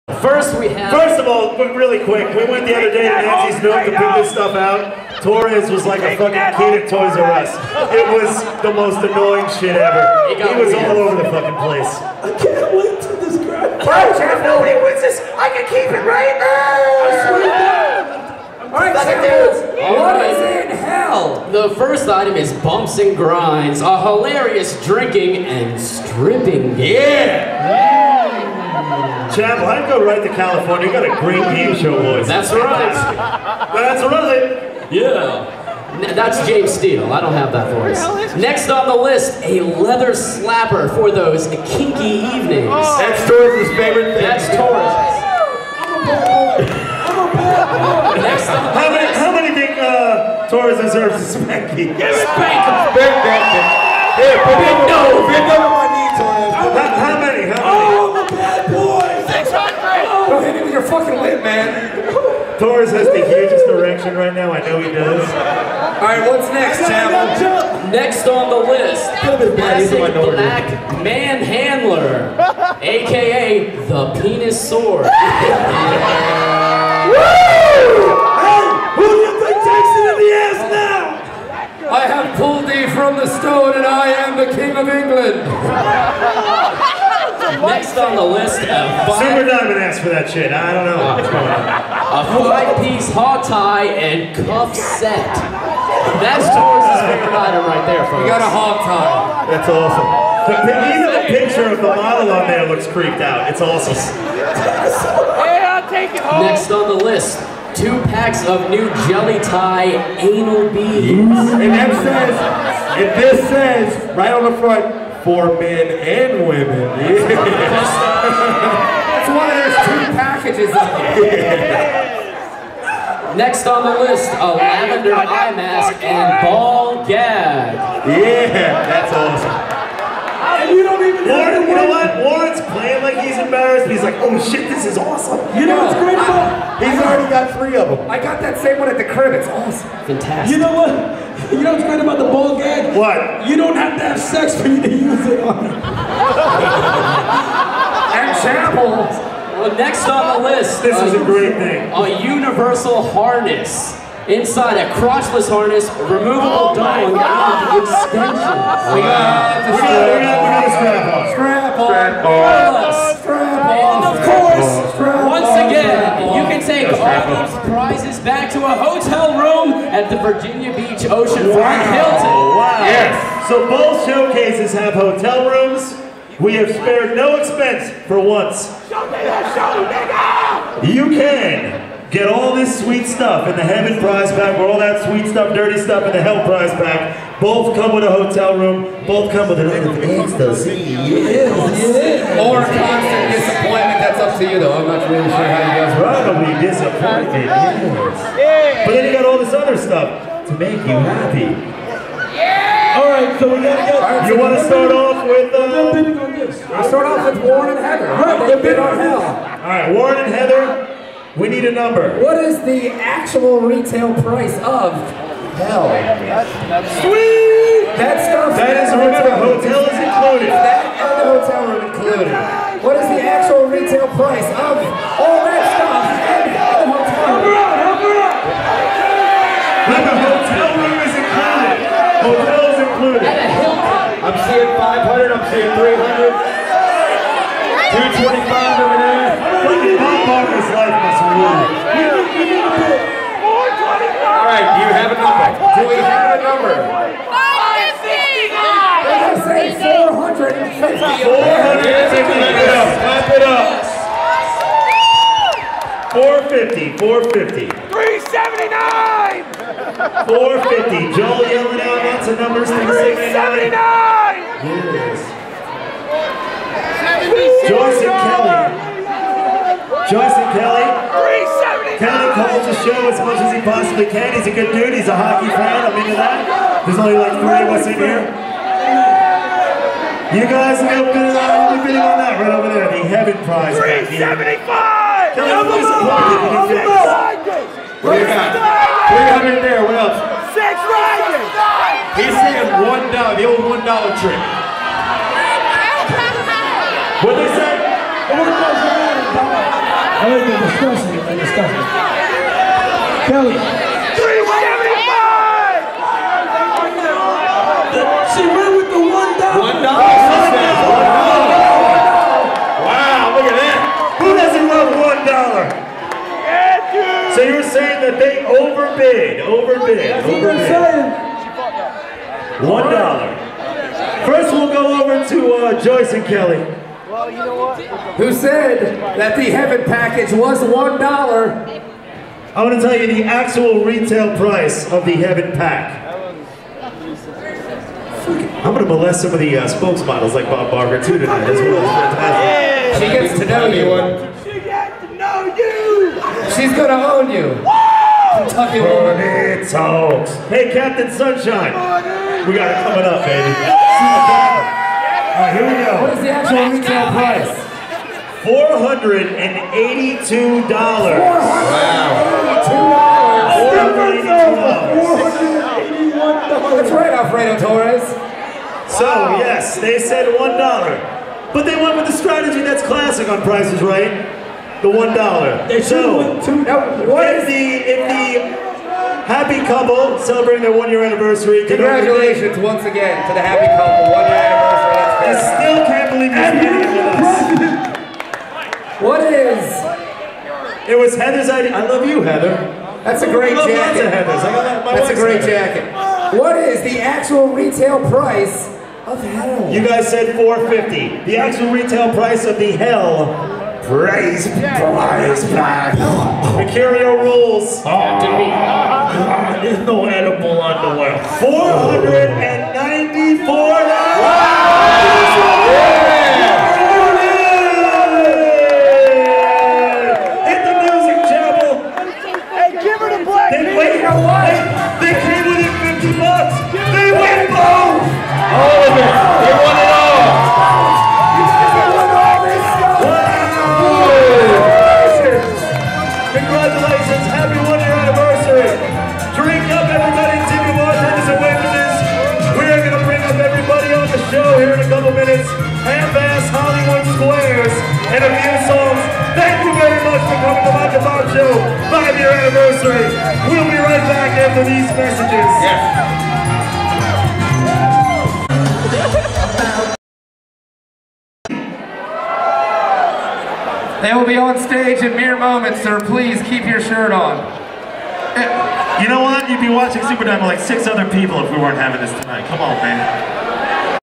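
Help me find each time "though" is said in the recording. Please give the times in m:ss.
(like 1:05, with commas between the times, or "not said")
3:14.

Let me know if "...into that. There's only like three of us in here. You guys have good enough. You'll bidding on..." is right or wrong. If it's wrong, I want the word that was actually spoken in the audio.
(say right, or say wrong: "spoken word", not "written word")
right.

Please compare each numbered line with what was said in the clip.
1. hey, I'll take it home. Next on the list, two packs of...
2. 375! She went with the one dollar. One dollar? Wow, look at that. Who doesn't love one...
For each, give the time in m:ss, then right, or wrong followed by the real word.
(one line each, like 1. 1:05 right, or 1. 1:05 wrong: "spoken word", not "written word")
1. 1:43 right
2. 5:03 right.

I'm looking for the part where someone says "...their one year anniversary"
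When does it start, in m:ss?
6:20.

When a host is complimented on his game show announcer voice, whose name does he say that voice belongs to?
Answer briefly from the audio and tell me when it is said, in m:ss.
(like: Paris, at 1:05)
James Steele, at 0:36.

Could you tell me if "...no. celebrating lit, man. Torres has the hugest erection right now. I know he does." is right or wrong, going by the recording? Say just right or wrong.
wrong.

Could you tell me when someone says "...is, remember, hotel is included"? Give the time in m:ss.
3:38.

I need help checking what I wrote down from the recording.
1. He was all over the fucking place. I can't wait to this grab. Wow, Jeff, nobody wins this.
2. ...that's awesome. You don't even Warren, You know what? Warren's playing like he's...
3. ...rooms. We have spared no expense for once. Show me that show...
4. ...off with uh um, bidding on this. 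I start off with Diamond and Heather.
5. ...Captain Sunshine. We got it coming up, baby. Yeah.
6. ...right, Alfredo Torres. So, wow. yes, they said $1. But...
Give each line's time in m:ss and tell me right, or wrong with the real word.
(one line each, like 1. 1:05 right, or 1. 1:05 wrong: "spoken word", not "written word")
1. 0:10 right
2. 2:08 right
3. 2:55 right
4. 3:24 wrong: "Warren", not "Diamond"
5. 5:50 right
6. 6:06 right.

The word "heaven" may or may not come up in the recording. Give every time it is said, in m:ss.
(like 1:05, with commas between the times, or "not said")
3:03, 4:43, 5:29, 5:35.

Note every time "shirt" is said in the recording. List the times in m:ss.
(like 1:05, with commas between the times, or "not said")
7:46.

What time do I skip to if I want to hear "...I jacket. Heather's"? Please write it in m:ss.
6:33.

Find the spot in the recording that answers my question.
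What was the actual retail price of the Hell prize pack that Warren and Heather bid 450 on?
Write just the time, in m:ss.
6:51.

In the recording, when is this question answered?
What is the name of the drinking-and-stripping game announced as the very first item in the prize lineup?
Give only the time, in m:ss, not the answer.
0:22.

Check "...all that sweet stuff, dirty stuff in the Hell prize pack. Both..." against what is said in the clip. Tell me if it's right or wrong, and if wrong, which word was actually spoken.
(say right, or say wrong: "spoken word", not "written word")
right.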